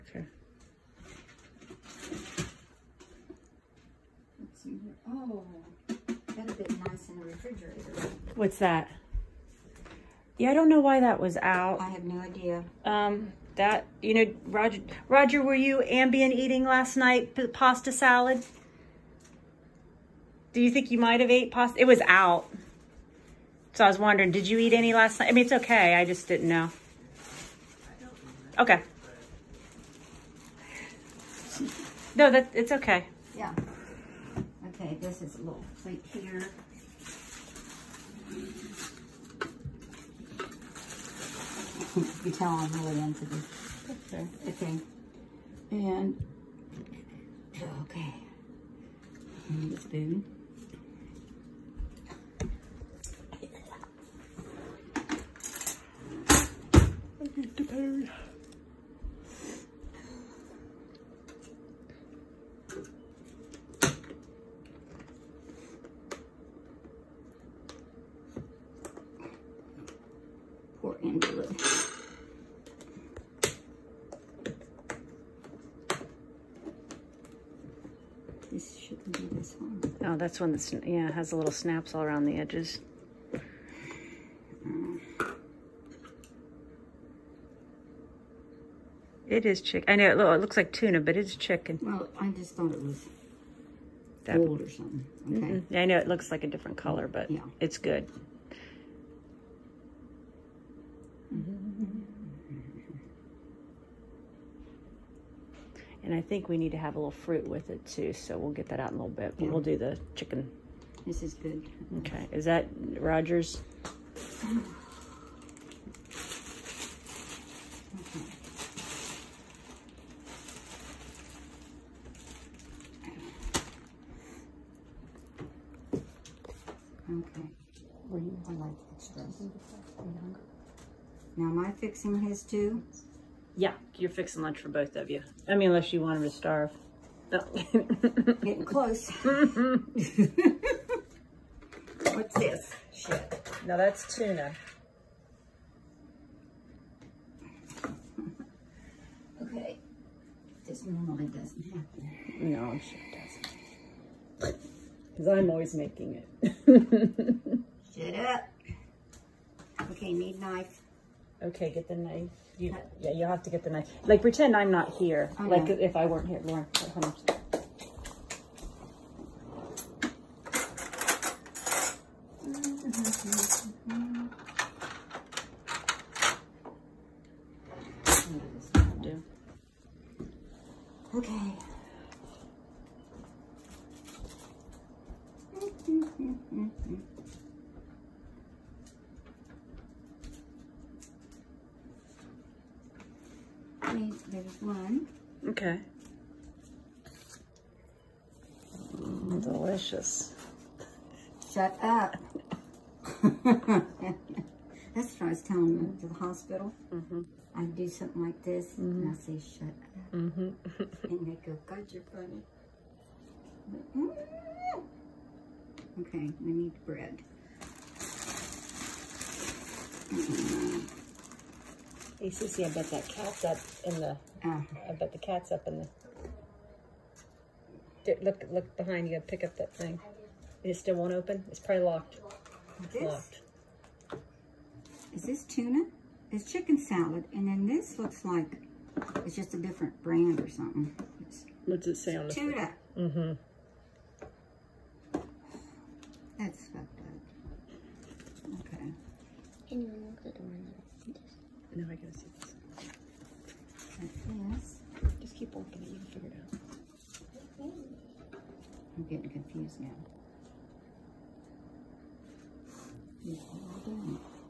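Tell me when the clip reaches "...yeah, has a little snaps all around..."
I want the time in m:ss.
1:20.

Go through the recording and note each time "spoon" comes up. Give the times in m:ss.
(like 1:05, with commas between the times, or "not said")
0:49.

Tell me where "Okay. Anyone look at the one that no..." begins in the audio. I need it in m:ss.
4:08.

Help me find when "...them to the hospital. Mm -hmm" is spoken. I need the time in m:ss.
3:25.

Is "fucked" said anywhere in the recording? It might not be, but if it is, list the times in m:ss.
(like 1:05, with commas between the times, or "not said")
4:06.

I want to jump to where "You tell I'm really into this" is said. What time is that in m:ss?
0:42.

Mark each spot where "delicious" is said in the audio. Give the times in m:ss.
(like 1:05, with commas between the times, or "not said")
3:19.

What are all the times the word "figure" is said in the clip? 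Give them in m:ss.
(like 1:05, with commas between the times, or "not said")
4:16.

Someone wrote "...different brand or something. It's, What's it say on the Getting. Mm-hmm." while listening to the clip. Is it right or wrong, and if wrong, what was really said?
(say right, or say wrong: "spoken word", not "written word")
wrong: "Tuna", not "Getting".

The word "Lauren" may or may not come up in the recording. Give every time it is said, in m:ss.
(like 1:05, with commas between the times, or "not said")
2:46.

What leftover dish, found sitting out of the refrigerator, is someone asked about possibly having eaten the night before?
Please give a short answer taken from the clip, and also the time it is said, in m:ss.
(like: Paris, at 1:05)
pasta salad, at 0:17.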